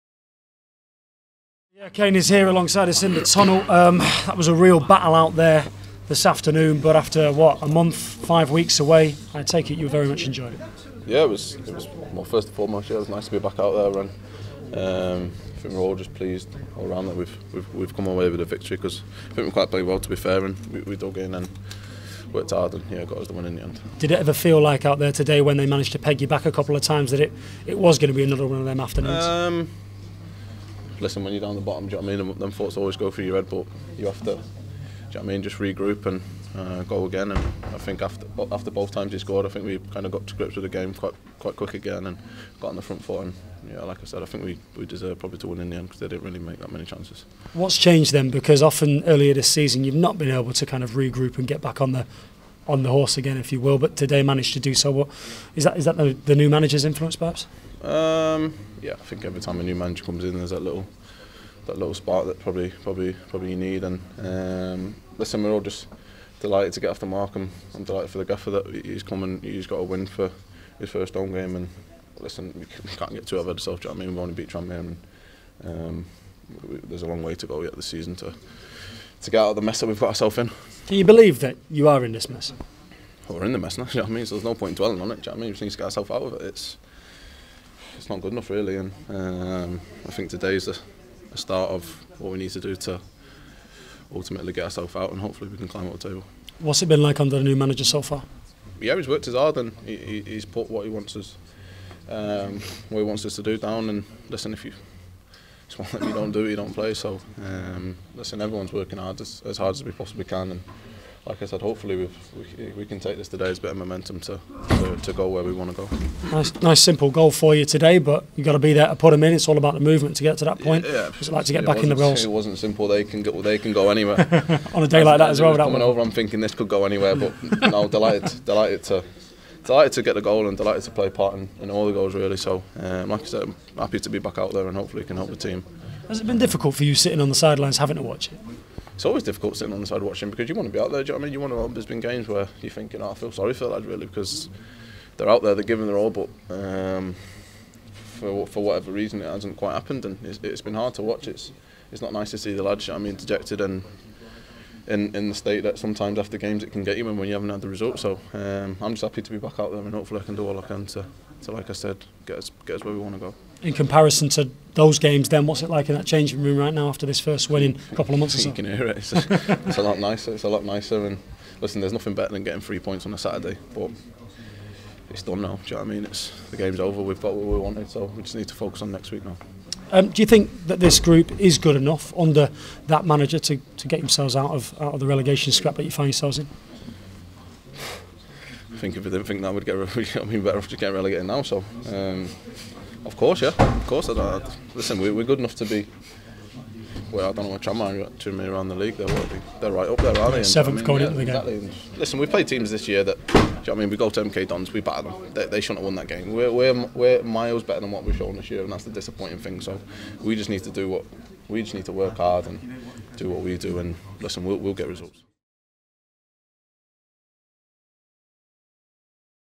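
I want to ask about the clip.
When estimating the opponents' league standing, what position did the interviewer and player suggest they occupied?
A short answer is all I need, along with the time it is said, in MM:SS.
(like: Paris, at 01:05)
Seventh, at 03:20.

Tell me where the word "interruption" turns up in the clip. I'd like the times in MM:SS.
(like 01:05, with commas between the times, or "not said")
not said.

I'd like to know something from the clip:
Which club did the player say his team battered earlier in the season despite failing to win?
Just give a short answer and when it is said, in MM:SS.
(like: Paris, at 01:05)
MK Dons, at 03:24.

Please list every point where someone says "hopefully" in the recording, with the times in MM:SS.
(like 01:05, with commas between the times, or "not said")
01:35, 01:51, 02:14, 02:39.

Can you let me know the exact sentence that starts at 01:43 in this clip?
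And listen, if you it's one that you don't do, it, you don't play.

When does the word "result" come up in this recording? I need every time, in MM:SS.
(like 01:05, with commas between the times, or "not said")
02:37, 03:34.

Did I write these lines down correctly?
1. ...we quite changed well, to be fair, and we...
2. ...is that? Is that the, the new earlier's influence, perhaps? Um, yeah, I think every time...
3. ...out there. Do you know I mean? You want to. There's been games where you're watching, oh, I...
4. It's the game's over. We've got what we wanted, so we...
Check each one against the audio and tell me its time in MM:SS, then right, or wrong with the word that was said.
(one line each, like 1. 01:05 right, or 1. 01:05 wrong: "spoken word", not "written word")
1. 00:19 wrong: "played", not "changed"
2. 00:55 wrong: "manager", not "earlier"
3. 02:20 wrong: "thinking", not "watching"
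4. 02:56 right.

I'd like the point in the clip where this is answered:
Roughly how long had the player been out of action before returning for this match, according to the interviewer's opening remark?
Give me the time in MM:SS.
00:07.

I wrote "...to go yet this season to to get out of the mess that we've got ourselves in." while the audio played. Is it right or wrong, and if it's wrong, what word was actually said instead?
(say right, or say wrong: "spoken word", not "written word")
right.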